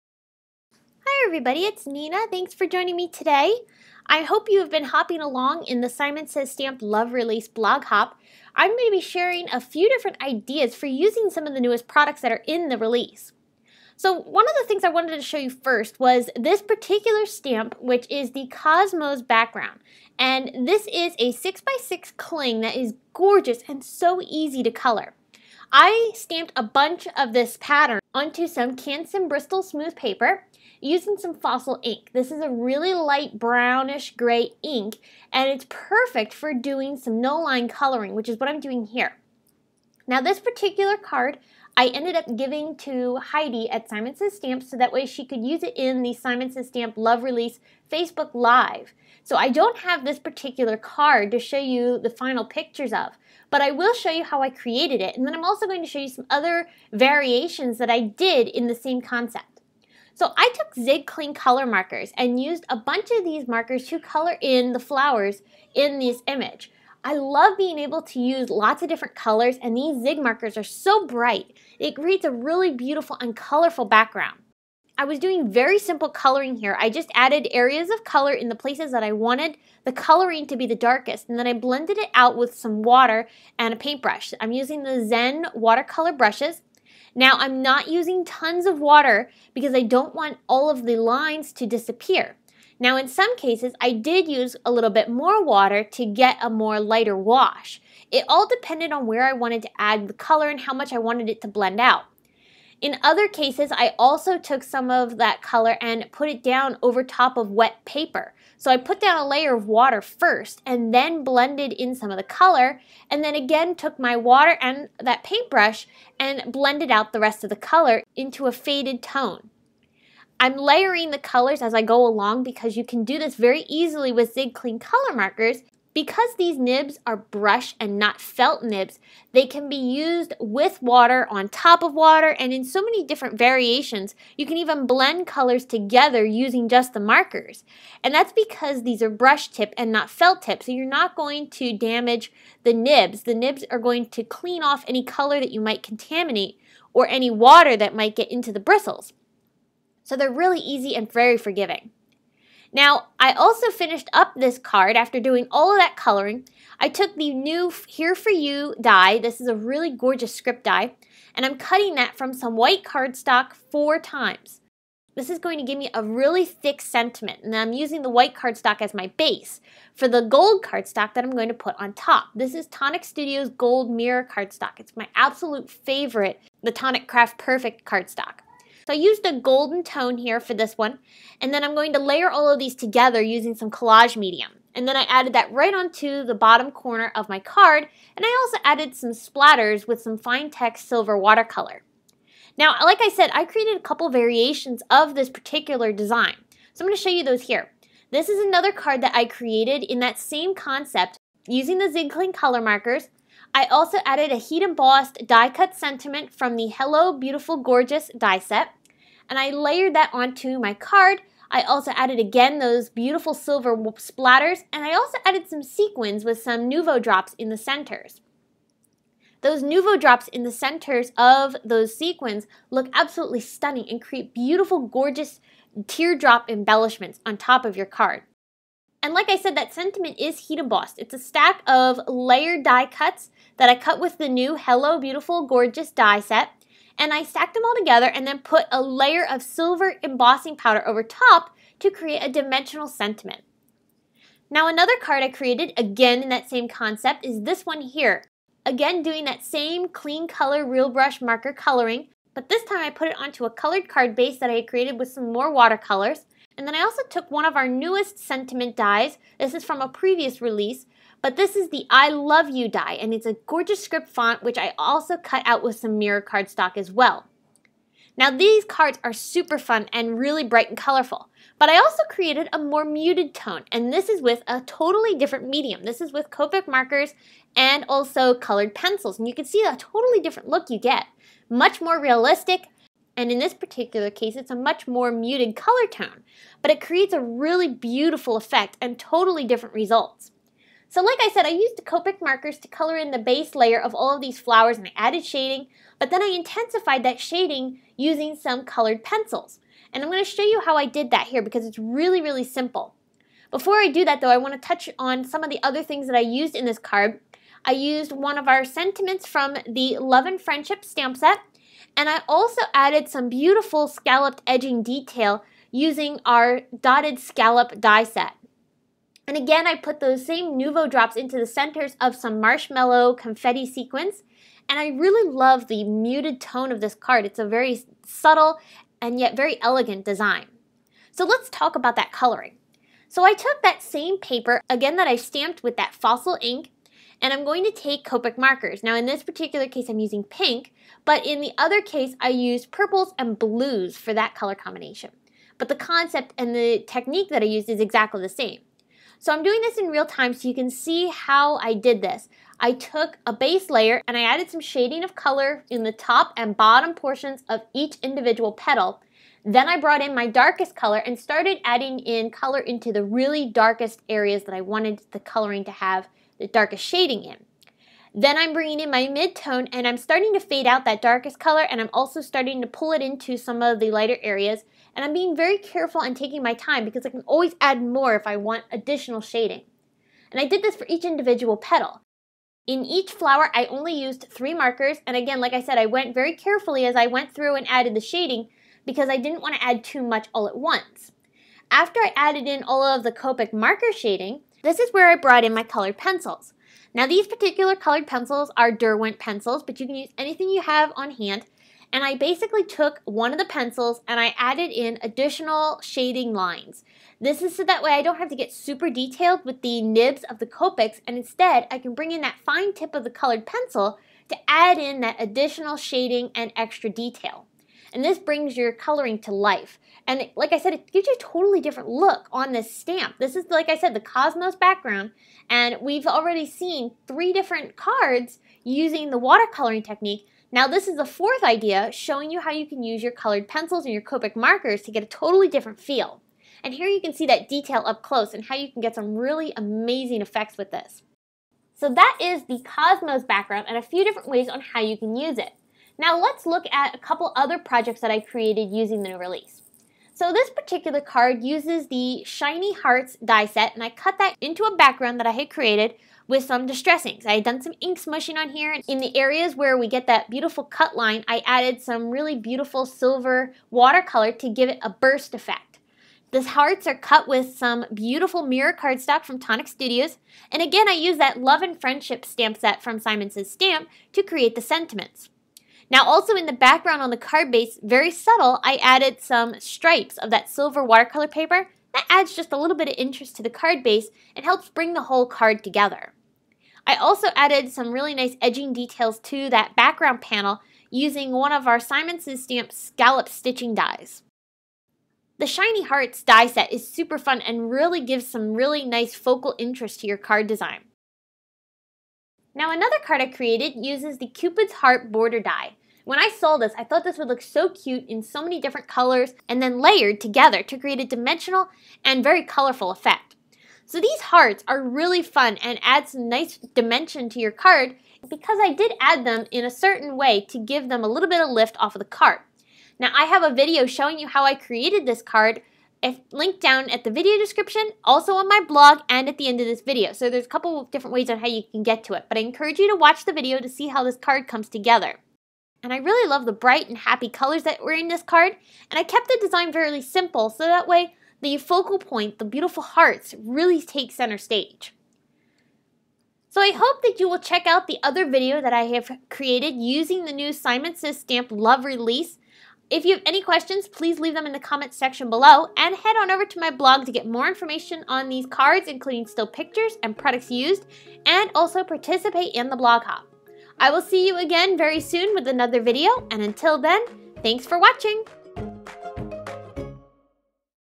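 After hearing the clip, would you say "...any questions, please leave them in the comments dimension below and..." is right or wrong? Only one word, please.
wrong.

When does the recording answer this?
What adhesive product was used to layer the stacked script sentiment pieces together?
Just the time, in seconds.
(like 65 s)
183 s.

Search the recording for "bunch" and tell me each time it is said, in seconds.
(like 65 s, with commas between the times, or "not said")
26 s, 62 s.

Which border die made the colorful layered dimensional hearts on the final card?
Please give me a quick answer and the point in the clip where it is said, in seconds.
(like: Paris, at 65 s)
Cupid's Heart, at 504 s.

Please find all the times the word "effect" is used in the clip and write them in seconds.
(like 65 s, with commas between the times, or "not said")
288 s, 440 s, 465 s, 512 s.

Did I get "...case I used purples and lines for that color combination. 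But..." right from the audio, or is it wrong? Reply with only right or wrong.
wrong.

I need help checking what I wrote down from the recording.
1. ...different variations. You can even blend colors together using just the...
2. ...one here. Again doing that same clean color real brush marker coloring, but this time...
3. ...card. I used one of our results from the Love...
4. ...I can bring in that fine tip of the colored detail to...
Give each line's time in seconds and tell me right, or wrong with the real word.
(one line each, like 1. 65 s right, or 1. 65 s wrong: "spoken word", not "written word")
1. 133 s right
2. 247 s right
3. 306 s wrong: "sentiments", not "results"
4. 411 s wrong: "pencil", not "detail".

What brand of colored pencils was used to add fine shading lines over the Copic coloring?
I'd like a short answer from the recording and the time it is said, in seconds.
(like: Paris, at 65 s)
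Derwent, at 398 s.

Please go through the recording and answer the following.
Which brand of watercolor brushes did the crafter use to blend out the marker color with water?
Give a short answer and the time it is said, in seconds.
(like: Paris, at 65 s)
Zen, at 85 s.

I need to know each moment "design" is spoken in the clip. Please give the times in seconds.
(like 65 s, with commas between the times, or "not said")
195 s, 330 s, 500 s, 539 s.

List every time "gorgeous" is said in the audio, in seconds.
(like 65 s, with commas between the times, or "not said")
23 s, 159 s, 207 s, 224 s, 235 s, 263 s.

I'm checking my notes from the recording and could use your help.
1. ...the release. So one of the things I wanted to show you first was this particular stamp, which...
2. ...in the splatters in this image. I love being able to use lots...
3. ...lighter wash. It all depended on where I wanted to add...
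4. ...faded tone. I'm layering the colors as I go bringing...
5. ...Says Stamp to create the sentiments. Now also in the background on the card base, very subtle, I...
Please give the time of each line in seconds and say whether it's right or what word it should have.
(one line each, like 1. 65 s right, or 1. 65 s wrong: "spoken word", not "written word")
1. 12 s right
2. 64 s wrong: "flowers", not "splatters"
3. 96 s right
4. 118 s wrong: "along", not "bringing"
5. 473 s right.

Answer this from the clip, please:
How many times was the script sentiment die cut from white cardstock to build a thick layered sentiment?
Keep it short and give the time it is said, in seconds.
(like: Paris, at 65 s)
4, at 163 s.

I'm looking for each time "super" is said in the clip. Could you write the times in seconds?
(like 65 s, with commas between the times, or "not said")
269 s, 408 s, 496 s.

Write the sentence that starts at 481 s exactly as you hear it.
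That adds just a little bit of interest to the card base and helps bring the whole card together.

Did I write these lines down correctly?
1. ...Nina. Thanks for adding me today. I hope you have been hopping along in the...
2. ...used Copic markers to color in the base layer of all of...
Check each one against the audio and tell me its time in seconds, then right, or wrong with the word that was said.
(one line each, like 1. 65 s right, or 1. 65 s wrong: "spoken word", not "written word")
1. 1 s wrong: "joining", not "adding"
2. 291 s right.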